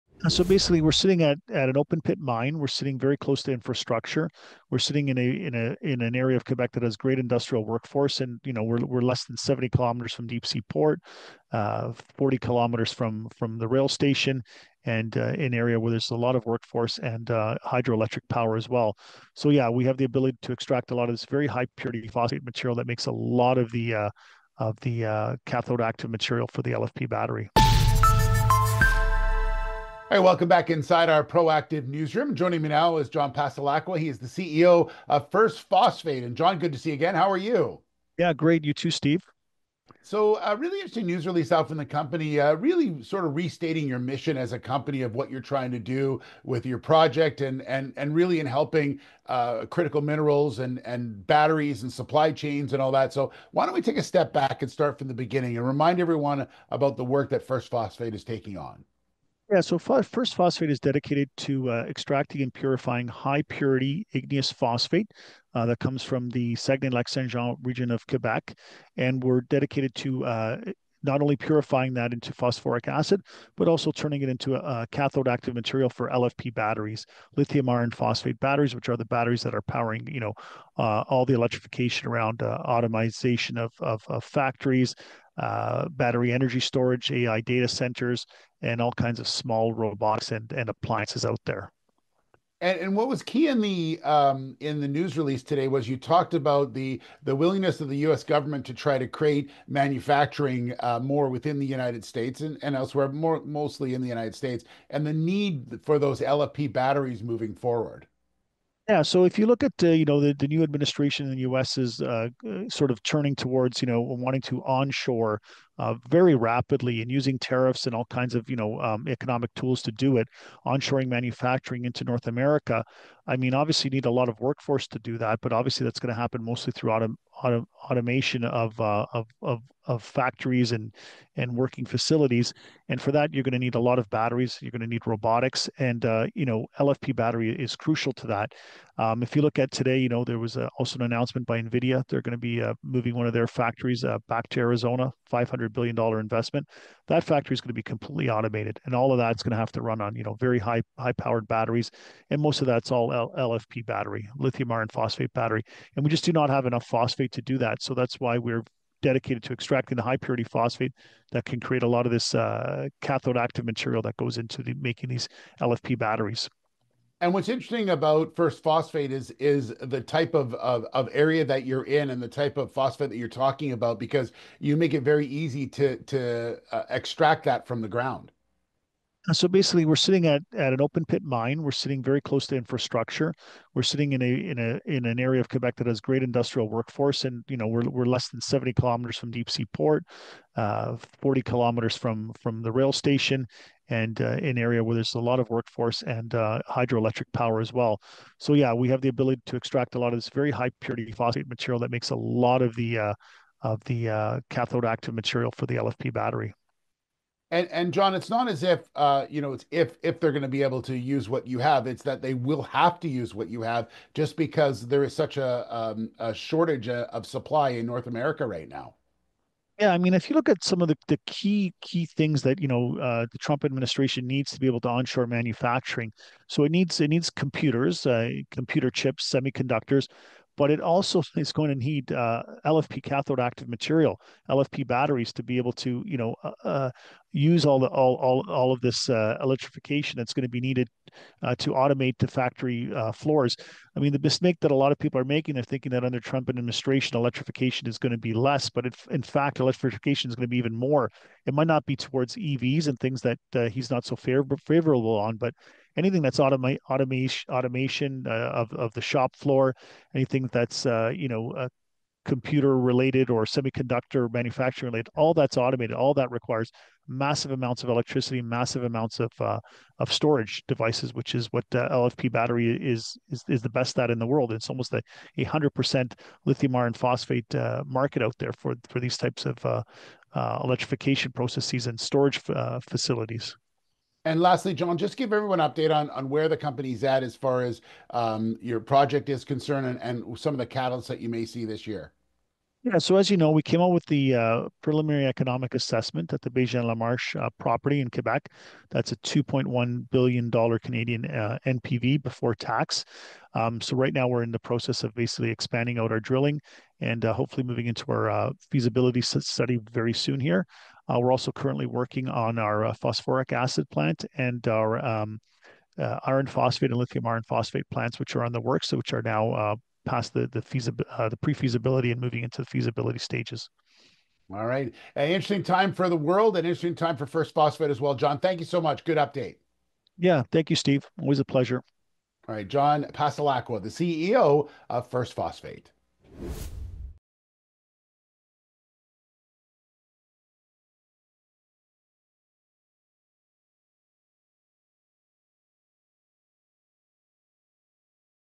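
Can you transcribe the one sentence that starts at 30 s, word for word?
All right, welcome back inside our proactive newsroom.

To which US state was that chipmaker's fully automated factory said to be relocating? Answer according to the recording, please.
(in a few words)
Arizona.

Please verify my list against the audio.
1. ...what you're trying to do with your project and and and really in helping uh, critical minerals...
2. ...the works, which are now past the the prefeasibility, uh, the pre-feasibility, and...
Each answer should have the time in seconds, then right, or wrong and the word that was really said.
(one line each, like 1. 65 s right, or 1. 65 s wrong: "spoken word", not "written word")
1. 45 s right
2. 318 s wrong: "feasibility", not "prefeasibility".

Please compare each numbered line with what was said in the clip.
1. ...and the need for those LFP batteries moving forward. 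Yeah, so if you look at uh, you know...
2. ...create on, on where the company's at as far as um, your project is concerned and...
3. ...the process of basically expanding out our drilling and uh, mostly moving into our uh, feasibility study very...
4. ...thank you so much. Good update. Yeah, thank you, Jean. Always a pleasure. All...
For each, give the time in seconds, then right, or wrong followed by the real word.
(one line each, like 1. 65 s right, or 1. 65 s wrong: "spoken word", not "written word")
1. 104 s right
2. 285 s wrong: "update", not "create"
3. 304 s wrong: "hopefully", not "mostly"
4. 328 s wrong: "Steve", not "Jean".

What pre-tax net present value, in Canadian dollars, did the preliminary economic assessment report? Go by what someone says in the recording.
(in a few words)
$2.1 billion.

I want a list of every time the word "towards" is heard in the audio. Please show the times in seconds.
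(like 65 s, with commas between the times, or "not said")
113 s, 251 s.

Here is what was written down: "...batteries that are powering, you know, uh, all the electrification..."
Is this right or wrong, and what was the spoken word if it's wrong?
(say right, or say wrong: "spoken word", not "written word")
right.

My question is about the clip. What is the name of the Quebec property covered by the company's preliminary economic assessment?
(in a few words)
Bégin-Lamarche.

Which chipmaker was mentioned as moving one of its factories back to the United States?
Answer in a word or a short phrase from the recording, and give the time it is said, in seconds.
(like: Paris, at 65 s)
Nvidia, at 141 s.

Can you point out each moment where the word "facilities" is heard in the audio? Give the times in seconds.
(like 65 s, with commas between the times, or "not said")
131 s, 282 s.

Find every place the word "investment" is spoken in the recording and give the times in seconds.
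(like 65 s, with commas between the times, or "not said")
146 s.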